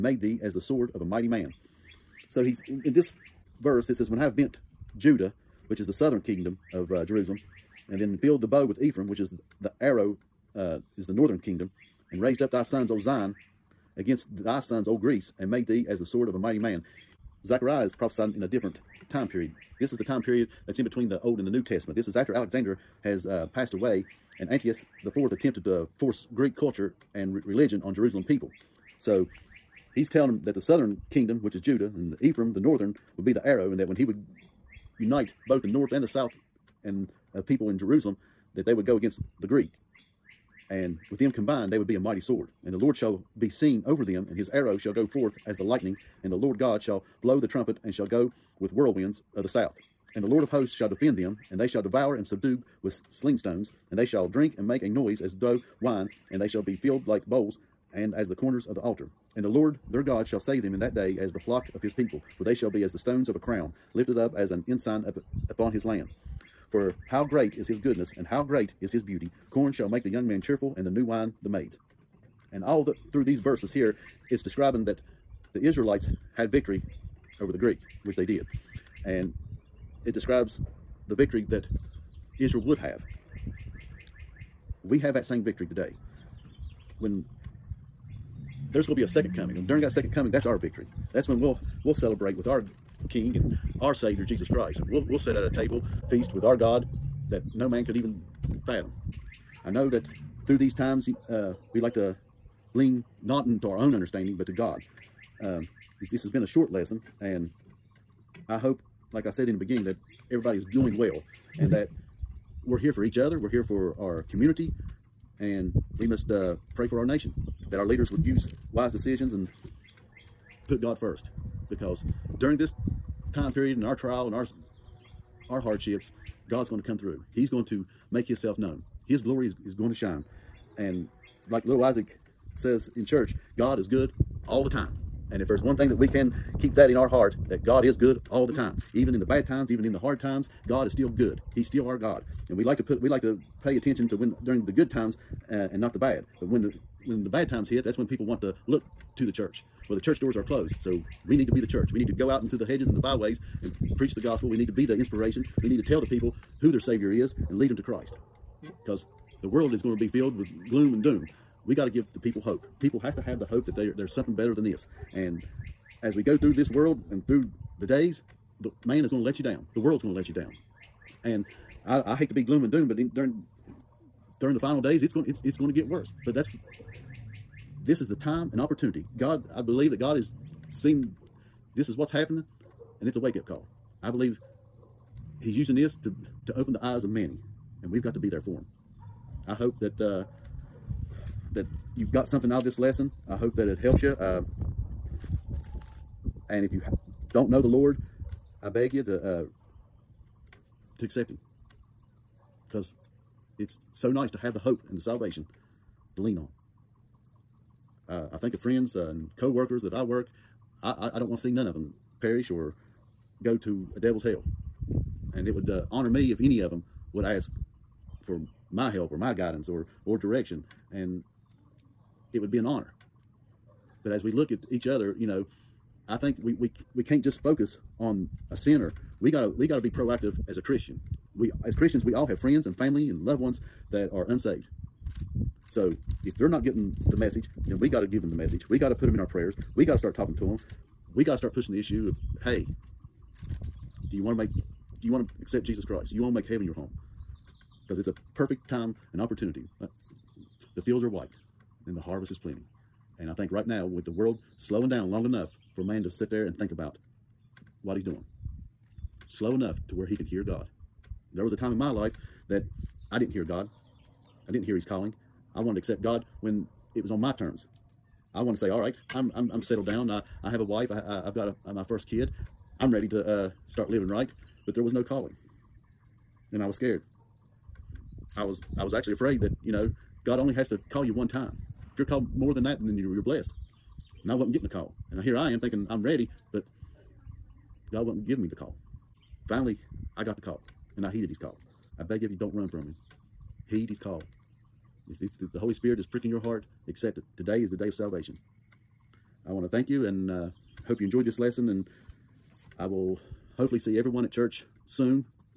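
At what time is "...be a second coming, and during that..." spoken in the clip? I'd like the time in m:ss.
1:28.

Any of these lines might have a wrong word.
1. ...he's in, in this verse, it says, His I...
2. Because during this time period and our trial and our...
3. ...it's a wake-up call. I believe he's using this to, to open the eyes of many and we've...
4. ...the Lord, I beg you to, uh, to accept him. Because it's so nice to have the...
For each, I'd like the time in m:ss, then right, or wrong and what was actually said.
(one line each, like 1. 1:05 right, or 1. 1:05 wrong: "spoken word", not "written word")
1. 0:02 wrong: "When", not "His"
2. 2:01 right
3. 3:03 right
4. 3:17 right.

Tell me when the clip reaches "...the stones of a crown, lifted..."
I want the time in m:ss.
1:02.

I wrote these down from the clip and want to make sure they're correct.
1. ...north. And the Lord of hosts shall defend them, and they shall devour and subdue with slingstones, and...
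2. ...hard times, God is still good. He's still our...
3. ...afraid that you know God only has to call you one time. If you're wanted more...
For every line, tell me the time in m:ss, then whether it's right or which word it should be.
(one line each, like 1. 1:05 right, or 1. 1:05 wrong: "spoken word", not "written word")
1. 0:49 wrong: "south", not "north"
2. 2:19 right
3. 4:39 wrong: "called", not "wanted".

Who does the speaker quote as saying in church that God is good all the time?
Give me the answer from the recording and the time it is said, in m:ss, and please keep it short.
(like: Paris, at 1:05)
Little Isaac, at 2:11.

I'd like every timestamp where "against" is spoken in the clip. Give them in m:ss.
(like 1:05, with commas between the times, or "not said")
0:13, 0:38.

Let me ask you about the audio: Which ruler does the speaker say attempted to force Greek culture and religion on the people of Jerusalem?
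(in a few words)
Antiochus the fourth.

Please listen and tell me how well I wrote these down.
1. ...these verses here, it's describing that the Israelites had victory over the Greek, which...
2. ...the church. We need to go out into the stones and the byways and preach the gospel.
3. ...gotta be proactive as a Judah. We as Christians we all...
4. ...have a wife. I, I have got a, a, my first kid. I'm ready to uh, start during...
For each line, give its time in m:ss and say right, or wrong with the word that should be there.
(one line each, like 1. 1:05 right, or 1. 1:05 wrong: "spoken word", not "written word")
1. 1:13 right
2. 2:31 wrong: "hedges", not "stones"
3. 3:49 wrong: "Christian", not "Judah"
4. 4:30 wrong: "living", not "during".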